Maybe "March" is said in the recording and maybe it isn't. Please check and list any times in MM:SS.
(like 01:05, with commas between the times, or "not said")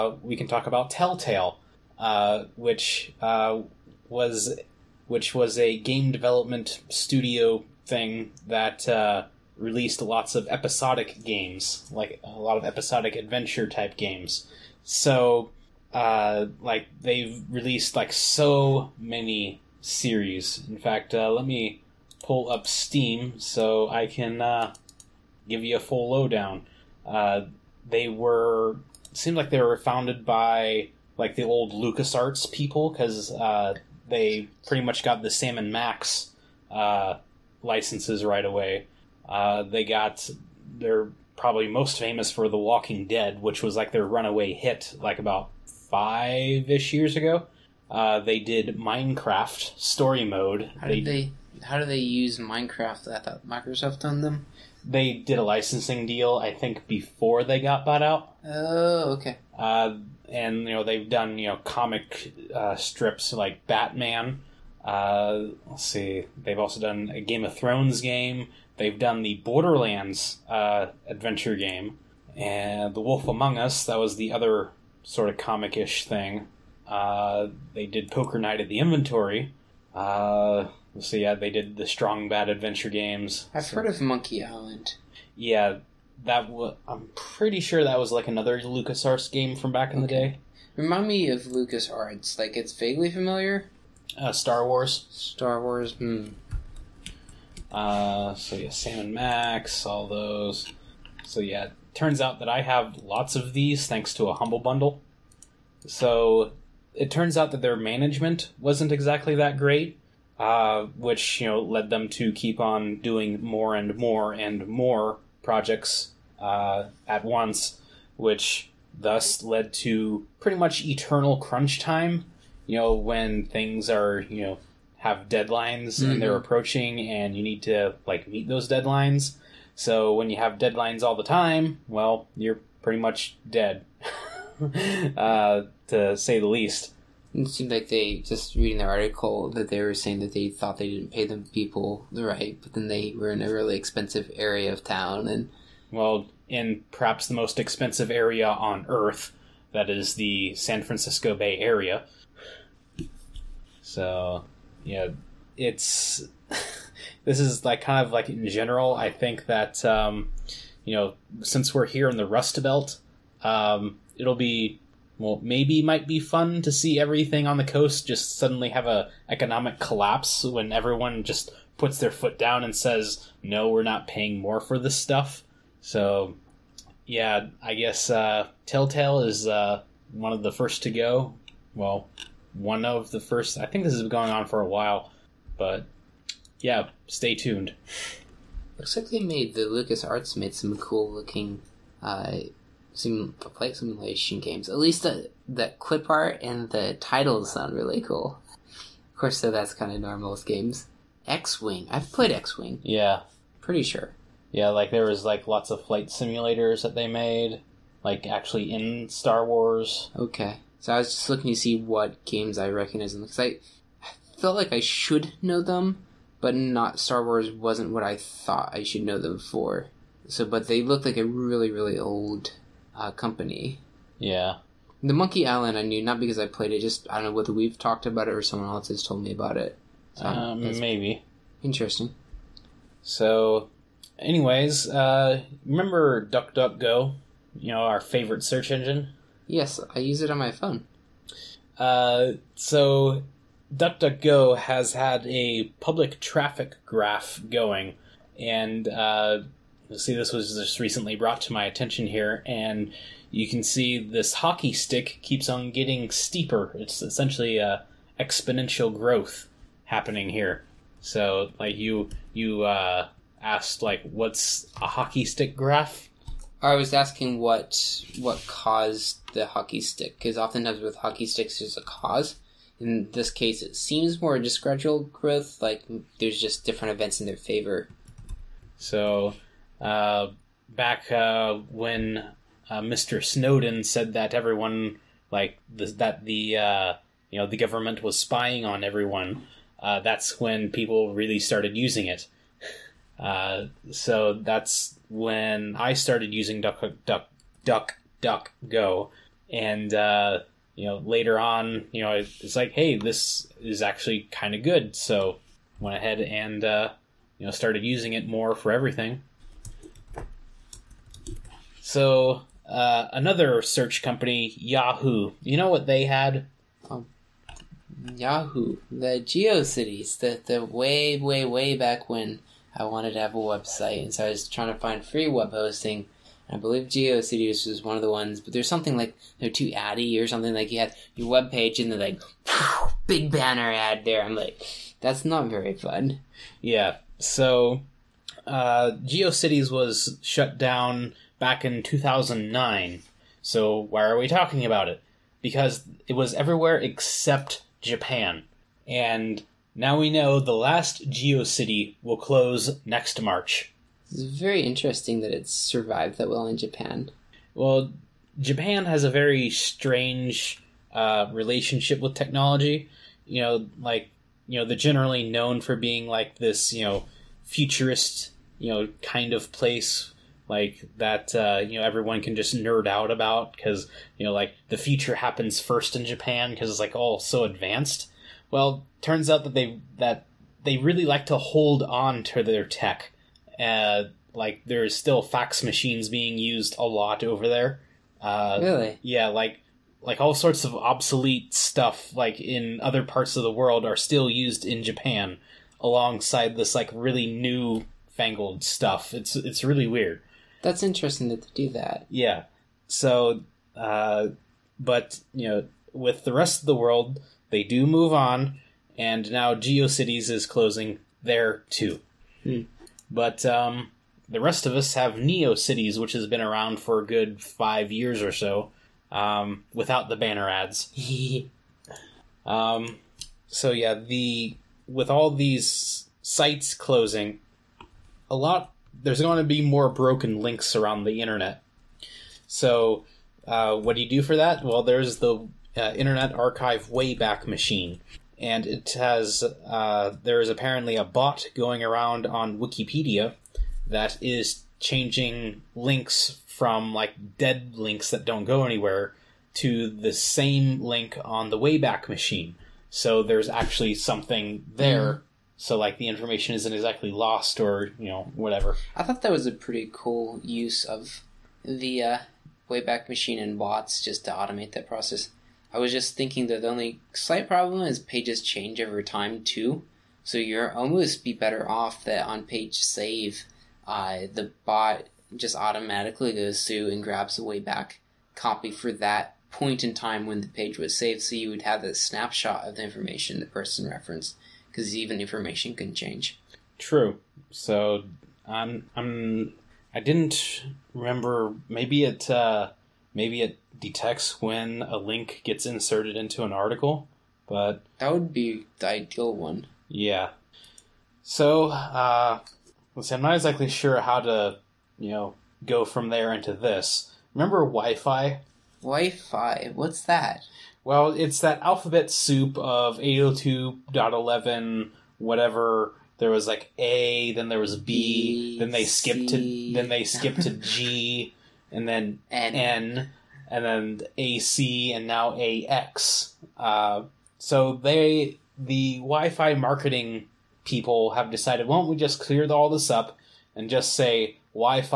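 05:53.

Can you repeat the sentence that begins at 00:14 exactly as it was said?
So uh, like they've released like so many series.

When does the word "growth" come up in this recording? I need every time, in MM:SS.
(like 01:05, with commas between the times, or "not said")
04:18, 04:35.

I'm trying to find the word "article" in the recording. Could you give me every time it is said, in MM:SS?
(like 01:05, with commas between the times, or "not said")
02:18, 08:16.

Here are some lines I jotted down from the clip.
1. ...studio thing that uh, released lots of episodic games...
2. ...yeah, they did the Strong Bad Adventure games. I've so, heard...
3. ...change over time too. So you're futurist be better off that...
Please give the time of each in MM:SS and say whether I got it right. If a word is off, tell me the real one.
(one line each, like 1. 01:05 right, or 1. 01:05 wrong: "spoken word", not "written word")
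1. 00:06 right
2. 01:21 right
3. 07:48 wrong: "almost", not "futurist".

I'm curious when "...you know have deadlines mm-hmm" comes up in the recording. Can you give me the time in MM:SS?
02:04.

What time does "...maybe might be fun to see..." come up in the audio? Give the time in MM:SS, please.
02:45.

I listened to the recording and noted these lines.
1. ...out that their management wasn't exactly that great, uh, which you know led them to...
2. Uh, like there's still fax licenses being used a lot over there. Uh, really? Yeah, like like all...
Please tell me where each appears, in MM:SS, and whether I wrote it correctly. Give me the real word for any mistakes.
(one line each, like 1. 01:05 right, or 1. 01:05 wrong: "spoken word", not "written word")
1. 01:47 right
2. 06:23 wrong: "machines", not "licenses".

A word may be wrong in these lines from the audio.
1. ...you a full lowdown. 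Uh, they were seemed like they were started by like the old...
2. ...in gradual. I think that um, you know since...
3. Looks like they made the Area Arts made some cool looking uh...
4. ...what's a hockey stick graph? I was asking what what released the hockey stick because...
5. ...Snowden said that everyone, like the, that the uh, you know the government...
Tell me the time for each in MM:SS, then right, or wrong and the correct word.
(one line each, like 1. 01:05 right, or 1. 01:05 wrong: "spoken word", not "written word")
1. 00:25 wrong: "founded", not "started"
2. 02:38 wrong: "general", not "gradual"
3. 03:08 wrong: "Lucas", not "Area"
4. 04:24 wrong: "caused", not "released"
5. 04:43 right.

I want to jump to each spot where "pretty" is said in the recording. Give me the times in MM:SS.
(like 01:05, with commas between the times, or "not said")
00:34, 01:27, 02:00, 02:12, 03:23, 07:39.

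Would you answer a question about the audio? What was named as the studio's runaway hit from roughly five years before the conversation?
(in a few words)
The Walking Dead.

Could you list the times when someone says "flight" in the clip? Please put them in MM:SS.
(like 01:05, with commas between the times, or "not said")
03:13, 03:25.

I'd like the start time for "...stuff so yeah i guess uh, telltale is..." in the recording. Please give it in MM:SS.
02:54.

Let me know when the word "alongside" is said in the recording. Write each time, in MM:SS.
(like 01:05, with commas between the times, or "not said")
06:35.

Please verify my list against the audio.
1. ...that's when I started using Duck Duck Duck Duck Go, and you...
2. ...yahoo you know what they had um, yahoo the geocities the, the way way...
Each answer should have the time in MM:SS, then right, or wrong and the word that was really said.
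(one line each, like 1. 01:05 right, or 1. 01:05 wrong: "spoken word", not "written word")
1. 04:54 right
2. 05:14 right.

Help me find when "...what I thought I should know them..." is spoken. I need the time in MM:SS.
03:37.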